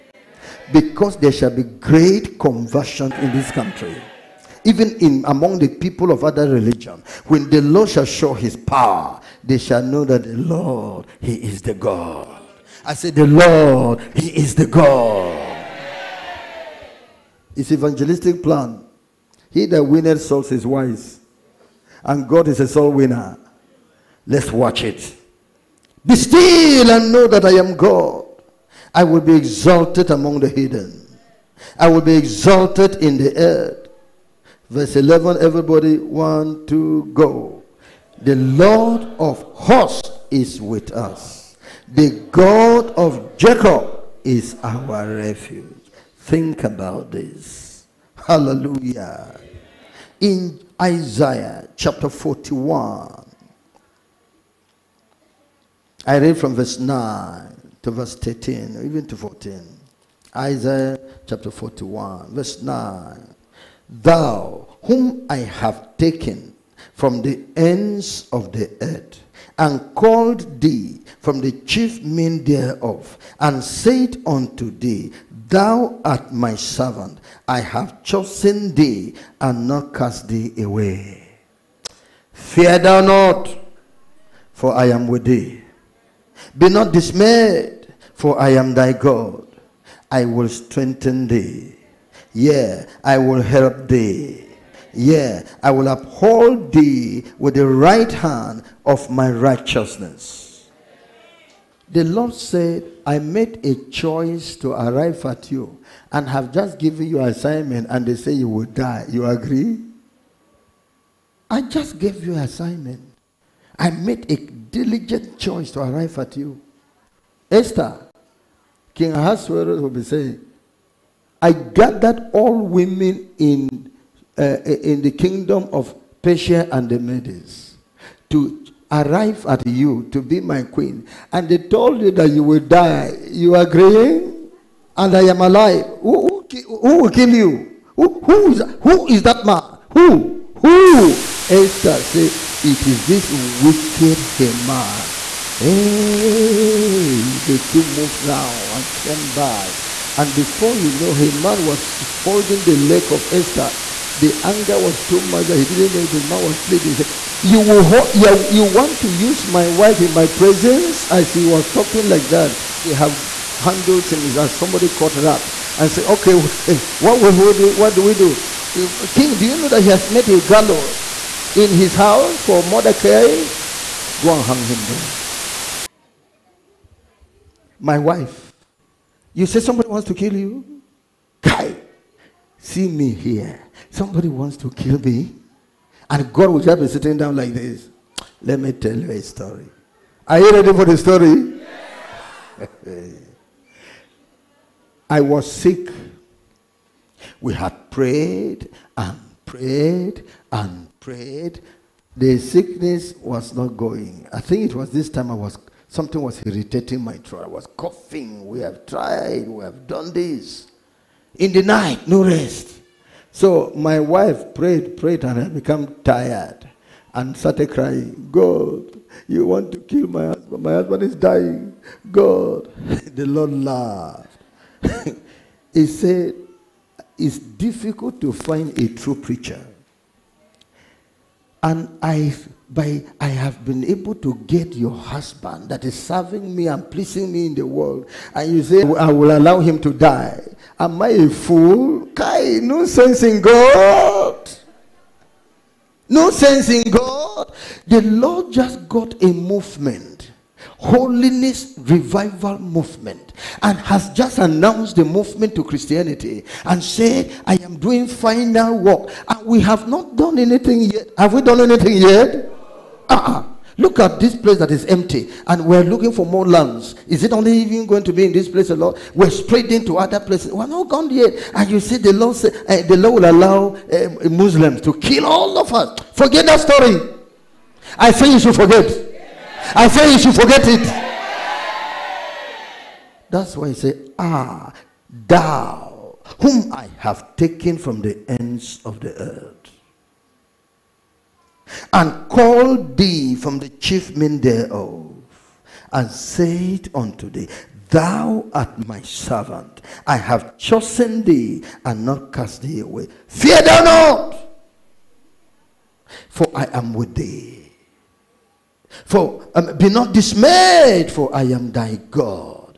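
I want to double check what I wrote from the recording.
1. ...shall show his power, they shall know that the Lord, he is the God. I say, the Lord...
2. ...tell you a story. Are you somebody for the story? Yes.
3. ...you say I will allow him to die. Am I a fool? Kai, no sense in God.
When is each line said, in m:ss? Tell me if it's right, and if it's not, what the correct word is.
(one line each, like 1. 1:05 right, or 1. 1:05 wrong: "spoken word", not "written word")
1. 0:07 right
2. 3:08 wrong: "ready", not "somebody"
3. 3:58 right.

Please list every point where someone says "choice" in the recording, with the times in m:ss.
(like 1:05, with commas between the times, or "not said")
1:43, 1:55.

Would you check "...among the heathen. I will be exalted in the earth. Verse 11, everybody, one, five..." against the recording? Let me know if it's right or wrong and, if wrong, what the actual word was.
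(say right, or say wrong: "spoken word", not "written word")
wrong: "two", not "five".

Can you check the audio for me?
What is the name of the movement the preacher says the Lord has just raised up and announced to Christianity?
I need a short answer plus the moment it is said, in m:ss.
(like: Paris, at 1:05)
Holiness revival movement, at 4:10.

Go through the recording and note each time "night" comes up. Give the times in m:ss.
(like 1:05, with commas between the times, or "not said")
3:31.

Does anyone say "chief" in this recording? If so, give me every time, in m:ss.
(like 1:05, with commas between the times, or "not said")
1:11, 4:53.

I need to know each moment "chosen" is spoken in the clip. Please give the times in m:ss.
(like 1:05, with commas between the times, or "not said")
1:18, 5:00.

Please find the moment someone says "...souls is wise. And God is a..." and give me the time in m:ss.
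0:20.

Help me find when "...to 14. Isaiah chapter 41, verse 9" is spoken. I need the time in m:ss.
0:59.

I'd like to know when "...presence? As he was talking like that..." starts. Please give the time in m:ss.
2:40.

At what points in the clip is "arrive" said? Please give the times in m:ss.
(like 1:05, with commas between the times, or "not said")
1:44, 1:55, 2:08.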